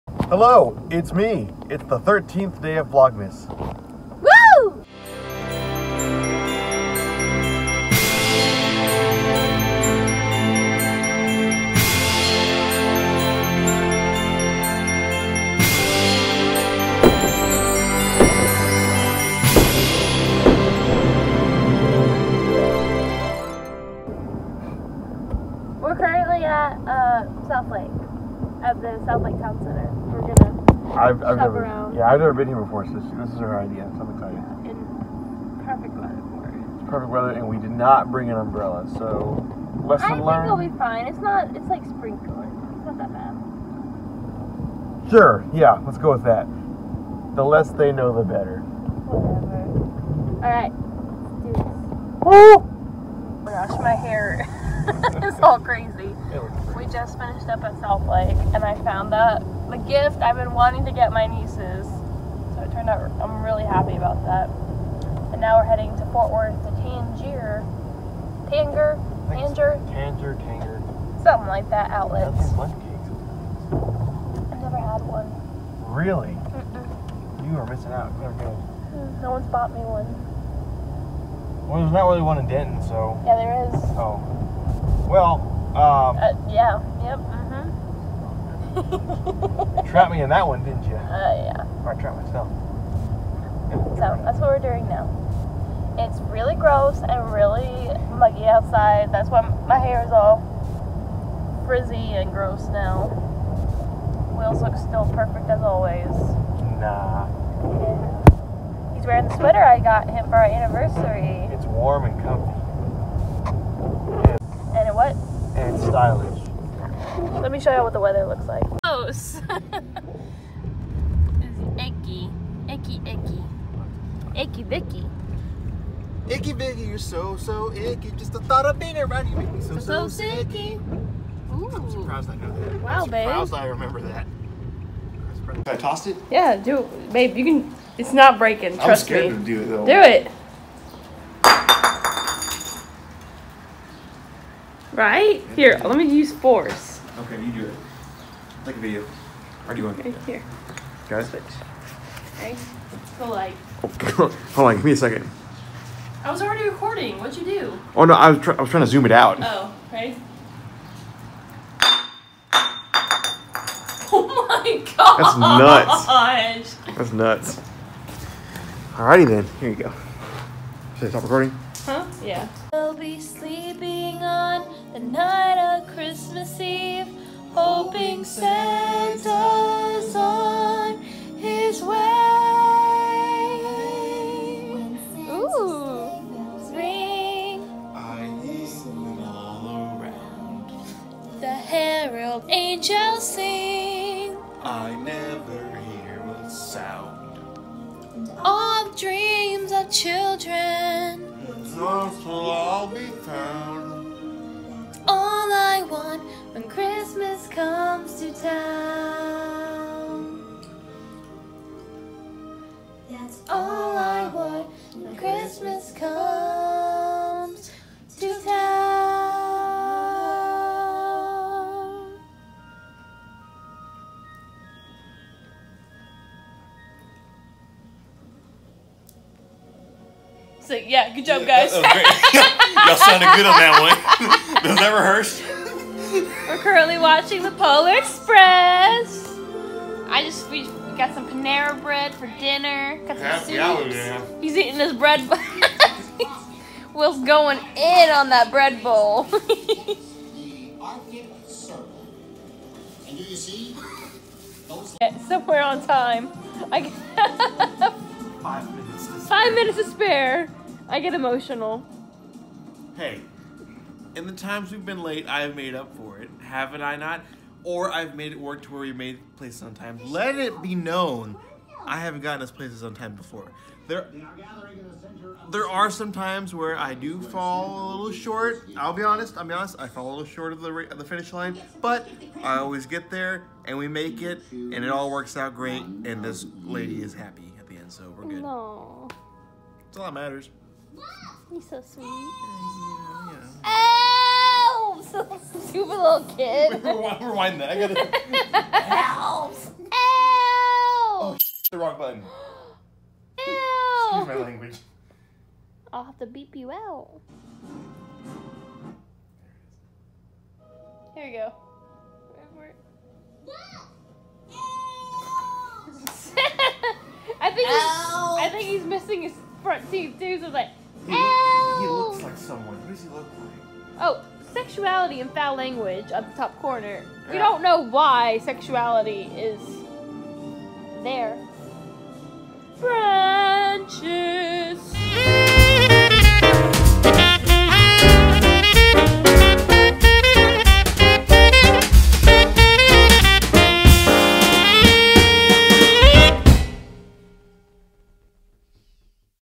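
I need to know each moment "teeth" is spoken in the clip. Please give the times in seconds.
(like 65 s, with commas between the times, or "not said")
319 s.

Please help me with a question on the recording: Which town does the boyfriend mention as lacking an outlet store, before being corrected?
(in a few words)
Denton.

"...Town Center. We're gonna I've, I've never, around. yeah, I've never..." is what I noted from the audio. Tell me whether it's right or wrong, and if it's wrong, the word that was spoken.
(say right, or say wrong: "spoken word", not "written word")
right.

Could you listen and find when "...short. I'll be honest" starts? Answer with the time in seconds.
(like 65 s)
278 s.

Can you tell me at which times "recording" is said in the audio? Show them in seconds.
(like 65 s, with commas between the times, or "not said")
156 s, 171 s.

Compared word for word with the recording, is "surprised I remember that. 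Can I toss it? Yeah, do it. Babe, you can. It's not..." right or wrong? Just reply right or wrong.
right.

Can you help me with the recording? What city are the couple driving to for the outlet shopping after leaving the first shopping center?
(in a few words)
Fort Worth.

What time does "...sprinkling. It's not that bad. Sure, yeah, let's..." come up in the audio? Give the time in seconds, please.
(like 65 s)
41 s.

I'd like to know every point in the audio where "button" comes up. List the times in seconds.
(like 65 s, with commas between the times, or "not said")
301 s.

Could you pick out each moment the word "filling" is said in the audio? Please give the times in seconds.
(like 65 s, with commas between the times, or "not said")
not said.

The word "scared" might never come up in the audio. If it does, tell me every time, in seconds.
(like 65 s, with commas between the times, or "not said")
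138 s.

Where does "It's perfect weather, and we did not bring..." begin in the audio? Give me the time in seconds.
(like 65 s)
36 s.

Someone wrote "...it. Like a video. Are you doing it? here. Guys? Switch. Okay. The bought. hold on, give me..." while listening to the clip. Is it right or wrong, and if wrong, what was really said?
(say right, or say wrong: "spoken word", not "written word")
wrong: "light", not "bought".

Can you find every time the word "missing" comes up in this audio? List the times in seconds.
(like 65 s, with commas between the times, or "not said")
77 s, 318 s.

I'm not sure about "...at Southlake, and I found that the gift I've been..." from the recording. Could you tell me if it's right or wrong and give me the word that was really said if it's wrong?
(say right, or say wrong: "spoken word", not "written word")
right.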